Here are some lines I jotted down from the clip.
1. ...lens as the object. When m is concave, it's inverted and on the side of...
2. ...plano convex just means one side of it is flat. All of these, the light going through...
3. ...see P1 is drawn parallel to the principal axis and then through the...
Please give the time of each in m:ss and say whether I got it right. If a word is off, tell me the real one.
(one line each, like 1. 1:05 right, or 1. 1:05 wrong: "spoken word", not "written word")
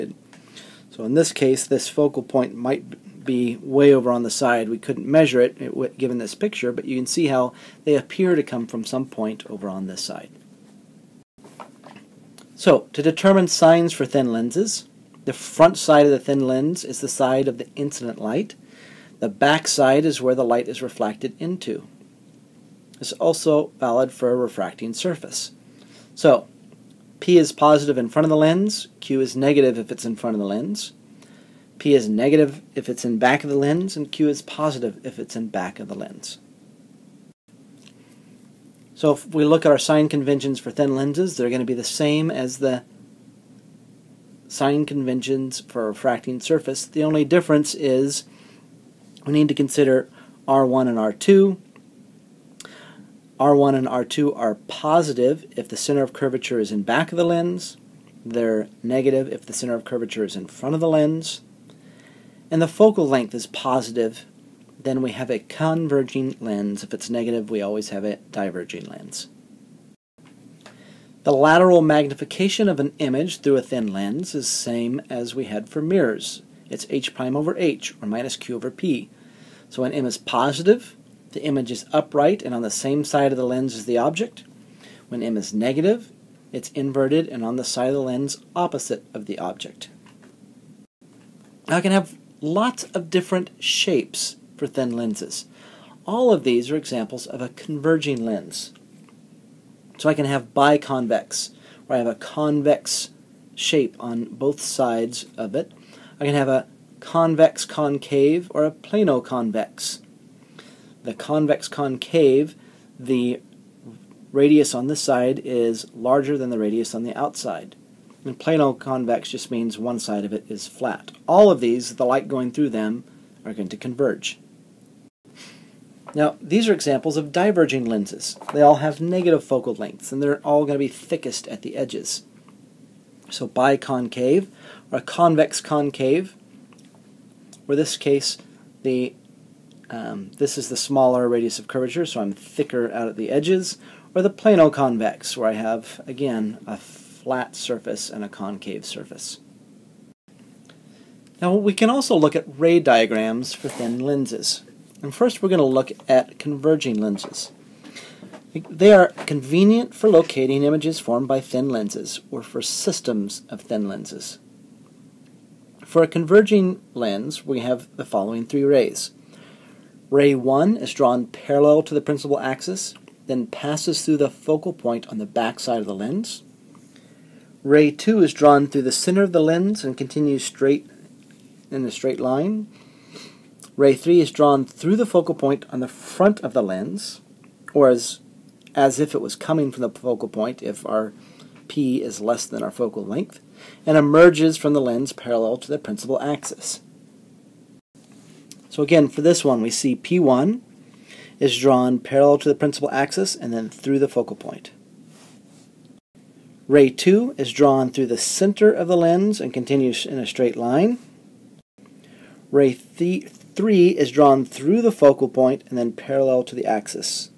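1. 1:23 wrong: "negative", not "concave"
2. 1:58 right
3. 3:19 right.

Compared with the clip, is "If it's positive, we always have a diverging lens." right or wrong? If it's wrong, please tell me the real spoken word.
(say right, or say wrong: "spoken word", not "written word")
wrong: "negative", not "positive".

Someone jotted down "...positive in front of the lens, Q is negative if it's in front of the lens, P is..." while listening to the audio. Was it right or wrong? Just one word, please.
right.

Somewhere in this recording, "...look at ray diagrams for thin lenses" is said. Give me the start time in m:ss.
2:32.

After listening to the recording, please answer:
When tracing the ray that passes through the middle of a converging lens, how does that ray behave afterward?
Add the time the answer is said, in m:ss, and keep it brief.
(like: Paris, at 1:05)
Continues in a straight line, at 2:59.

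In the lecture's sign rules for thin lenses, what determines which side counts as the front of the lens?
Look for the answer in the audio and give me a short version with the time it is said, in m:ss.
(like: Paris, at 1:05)
The side of the incident light, at 0:16.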